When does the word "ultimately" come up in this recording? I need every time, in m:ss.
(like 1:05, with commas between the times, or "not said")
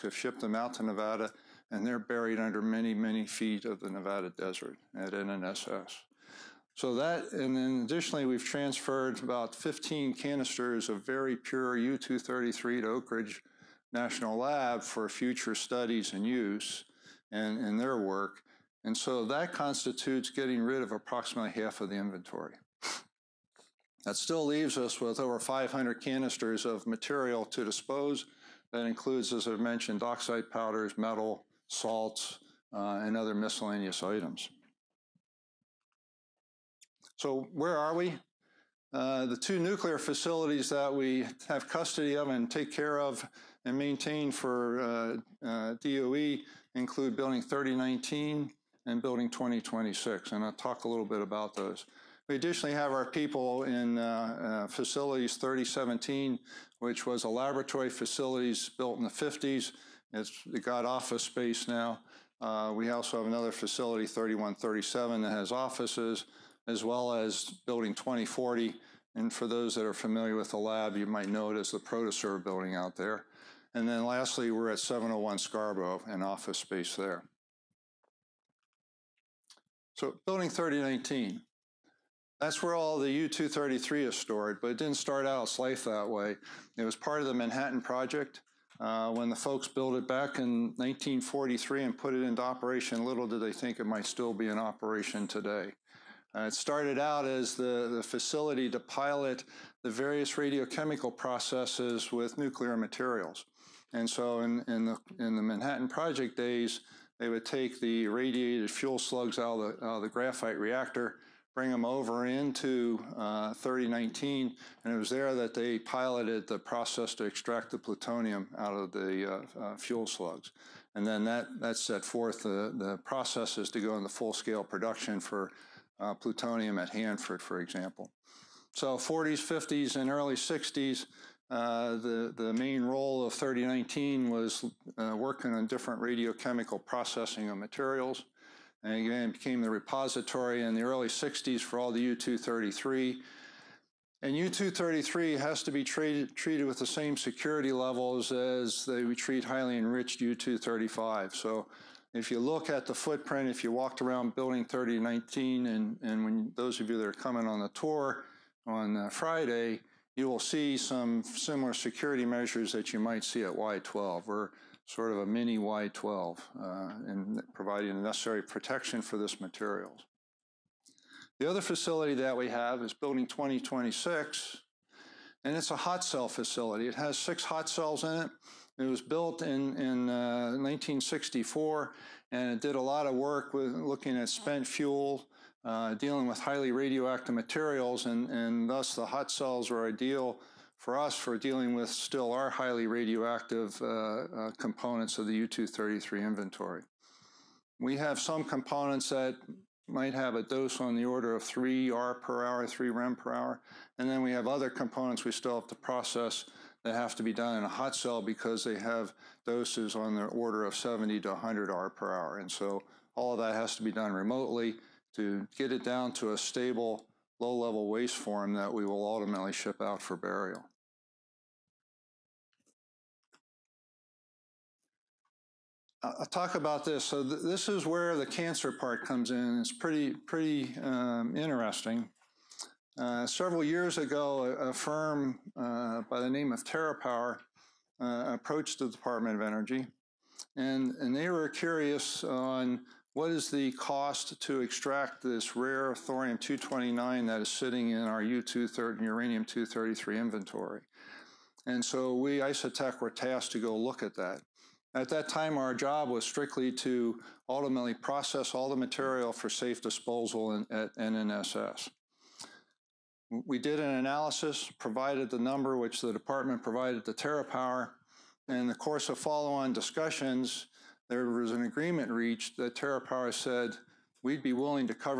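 3:39, 4:17.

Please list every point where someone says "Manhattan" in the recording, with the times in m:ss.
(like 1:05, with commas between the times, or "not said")
1:27, 1:45.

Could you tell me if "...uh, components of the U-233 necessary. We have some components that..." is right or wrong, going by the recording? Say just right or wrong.
wrong.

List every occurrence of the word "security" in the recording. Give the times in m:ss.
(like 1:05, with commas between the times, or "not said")
2:27, 2:41.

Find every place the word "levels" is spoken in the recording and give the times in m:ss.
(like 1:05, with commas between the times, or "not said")
2:27, 3:37.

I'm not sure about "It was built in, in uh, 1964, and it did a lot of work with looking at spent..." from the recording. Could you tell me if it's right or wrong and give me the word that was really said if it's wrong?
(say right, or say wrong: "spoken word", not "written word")
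right.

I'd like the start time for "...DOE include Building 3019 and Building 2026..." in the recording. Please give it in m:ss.
0:45.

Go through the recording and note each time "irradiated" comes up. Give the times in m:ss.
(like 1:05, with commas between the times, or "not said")
1:48.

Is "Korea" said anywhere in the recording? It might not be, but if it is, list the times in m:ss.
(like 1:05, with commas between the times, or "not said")
not said.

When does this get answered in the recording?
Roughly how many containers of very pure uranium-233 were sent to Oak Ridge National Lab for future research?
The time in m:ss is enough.
0:09.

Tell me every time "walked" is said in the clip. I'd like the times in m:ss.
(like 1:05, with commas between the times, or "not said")
2:33.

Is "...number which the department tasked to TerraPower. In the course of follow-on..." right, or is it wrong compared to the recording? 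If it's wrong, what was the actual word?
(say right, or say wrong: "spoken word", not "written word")
wrong: "provided", not "tasked".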